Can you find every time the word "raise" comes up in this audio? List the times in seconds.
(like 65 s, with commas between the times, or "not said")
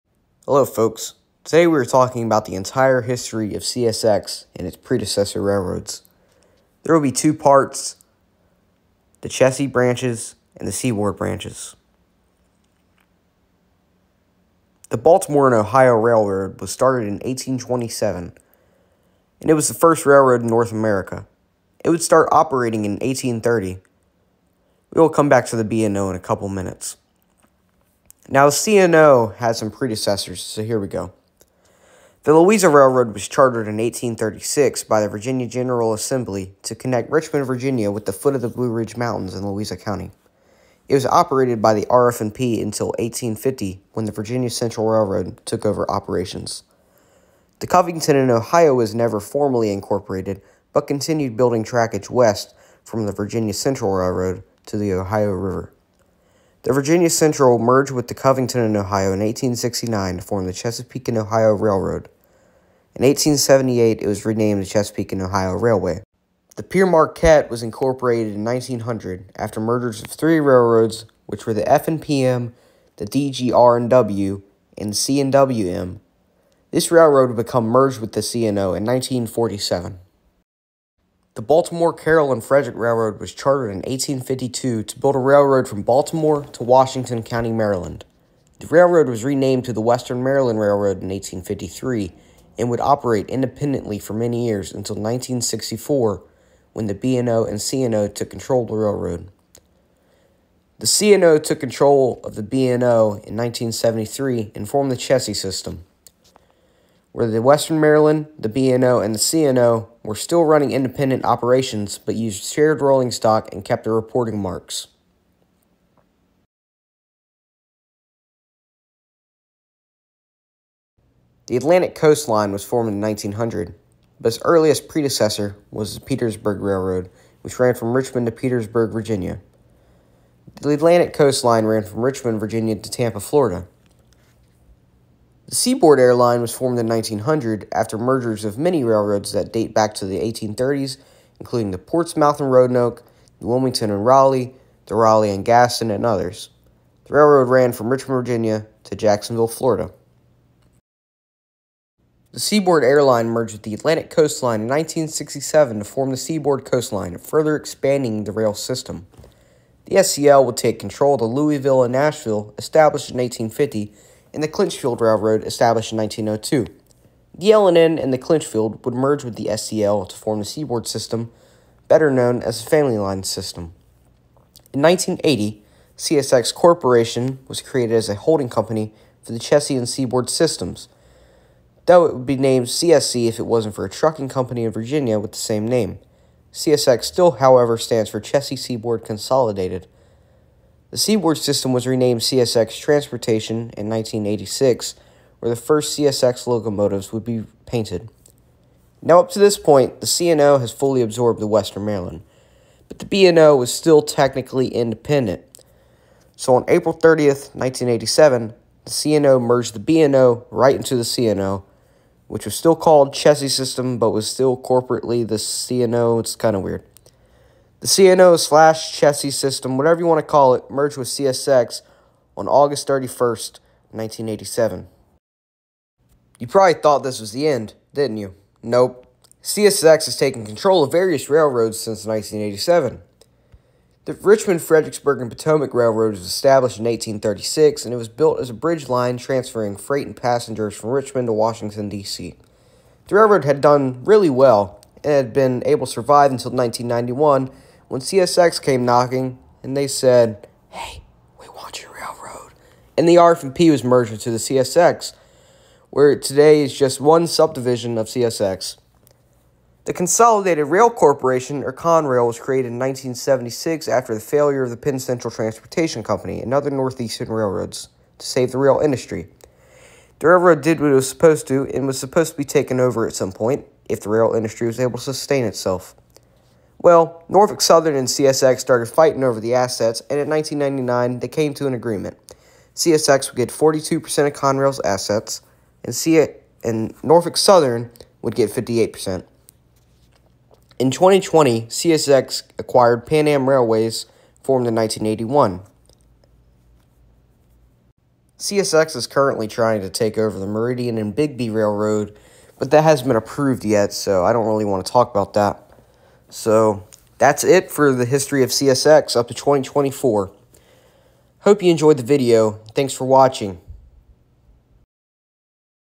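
not said.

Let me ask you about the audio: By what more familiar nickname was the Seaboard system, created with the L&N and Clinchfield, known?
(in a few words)
Family Line system.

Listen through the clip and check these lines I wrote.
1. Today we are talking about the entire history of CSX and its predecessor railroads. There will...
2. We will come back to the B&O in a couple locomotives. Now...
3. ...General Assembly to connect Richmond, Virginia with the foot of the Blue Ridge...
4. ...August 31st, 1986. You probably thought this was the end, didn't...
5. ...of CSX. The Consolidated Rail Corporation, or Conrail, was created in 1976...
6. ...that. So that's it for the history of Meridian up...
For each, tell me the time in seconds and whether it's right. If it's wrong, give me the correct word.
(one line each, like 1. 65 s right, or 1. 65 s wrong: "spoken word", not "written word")
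1. 1 s right
2. 24 s wrong: "minutes", not "locomotives"
3. 35 s right
4. 222 s wrong: "1987", not "1986"
5. 257 s right
6. 305 s wrong: "CSX", not "Meridian".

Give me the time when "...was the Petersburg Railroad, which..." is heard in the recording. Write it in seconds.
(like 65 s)
125 s.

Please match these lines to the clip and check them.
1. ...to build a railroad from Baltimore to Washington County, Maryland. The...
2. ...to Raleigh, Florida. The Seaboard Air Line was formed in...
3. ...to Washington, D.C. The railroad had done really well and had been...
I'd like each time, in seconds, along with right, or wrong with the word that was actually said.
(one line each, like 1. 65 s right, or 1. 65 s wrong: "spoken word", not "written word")
1. 84 s right
2. 132 s wrong: "Tampa", not "Raleigh"
3. 241 s right.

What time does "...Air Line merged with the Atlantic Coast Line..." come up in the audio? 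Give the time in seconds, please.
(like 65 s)
152 s.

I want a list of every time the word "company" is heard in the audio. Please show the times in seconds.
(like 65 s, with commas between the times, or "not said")
178 s, 184 s, 266 s.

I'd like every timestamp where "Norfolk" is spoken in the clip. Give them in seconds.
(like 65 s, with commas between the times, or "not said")
277 s, 287 s.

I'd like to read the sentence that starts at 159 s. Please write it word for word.
The SCL would take control of the Louisville and Nashville, established in 1850, and the Clinchfield Railroad established in 1902.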